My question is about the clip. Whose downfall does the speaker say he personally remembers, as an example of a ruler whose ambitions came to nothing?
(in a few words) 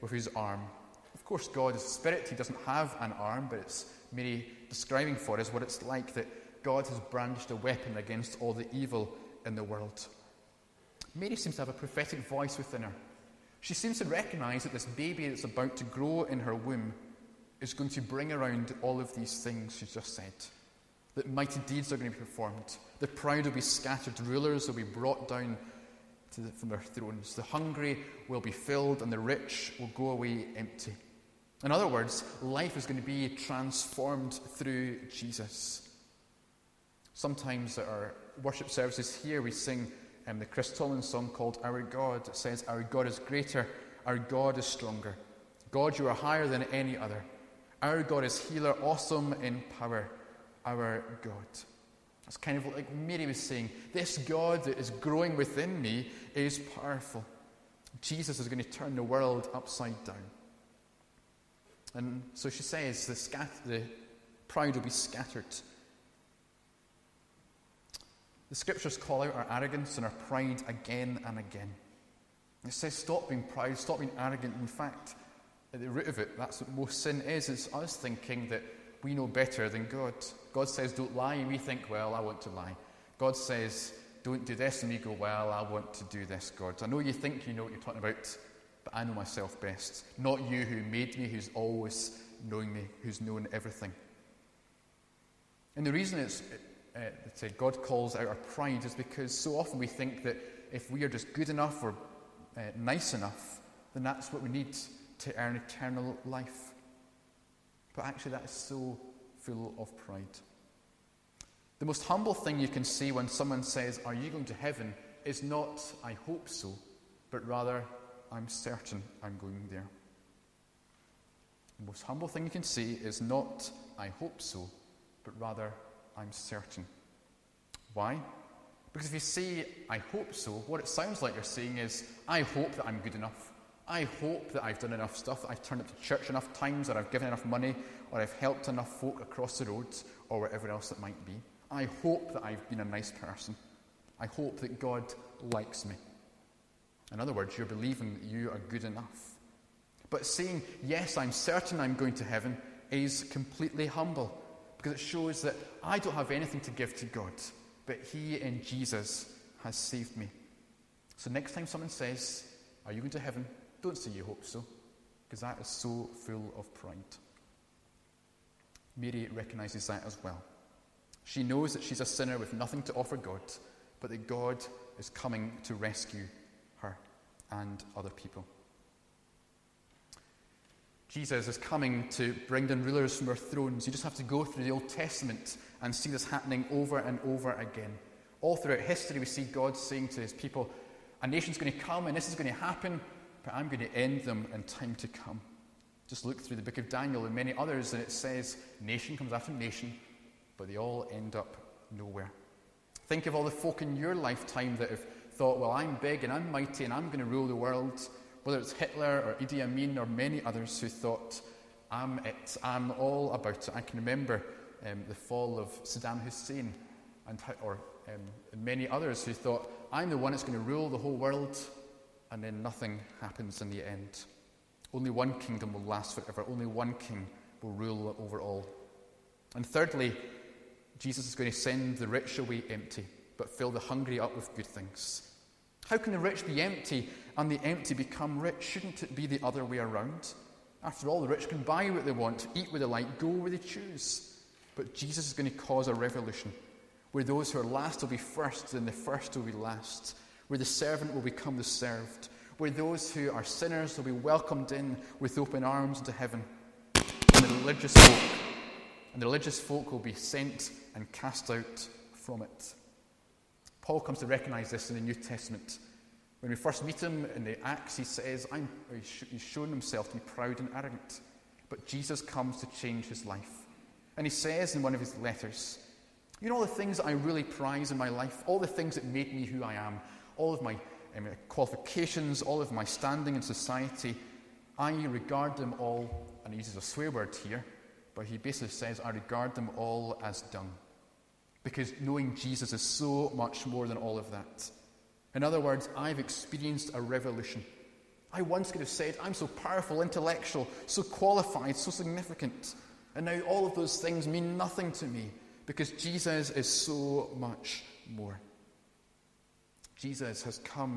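Saddam Hussein.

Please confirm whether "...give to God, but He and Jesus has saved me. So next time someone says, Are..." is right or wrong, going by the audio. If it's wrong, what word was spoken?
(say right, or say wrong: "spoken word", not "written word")
right.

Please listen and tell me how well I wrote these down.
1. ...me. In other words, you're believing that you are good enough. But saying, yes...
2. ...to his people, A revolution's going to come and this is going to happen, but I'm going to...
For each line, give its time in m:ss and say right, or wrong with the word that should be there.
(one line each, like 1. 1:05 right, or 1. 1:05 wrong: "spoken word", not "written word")
1. 2:25 right
2. 3:10 wrong: "nation", not "revolution".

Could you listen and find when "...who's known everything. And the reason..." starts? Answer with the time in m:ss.
1:33.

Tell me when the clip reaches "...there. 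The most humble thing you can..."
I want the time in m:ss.
1:59.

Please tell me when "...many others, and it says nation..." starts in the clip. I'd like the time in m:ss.
3:17.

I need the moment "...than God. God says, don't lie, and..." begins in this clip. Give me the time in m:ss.
1:19.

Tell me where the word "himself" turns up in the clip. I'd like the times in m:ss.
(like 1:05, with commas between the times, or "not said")
4:29.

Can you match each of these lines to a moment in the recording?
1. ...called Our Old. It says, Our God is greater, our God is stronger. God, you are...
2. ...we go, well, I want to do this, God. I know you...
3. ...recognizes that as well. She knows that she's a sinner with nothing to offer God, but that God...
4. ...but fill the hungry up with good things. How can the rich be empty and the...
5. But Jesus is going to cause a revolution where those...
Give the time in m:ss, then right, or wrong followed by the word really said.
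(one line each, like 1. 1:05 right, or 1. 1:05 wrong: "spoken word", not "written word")
1. 0:41 wrong: "God", not "Old"
2. 1:24 right
3. 2:49 right
4. 3:53 right
5. 4:04 right.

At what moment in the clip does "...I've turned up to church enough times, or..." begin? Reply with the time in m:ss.
2:15.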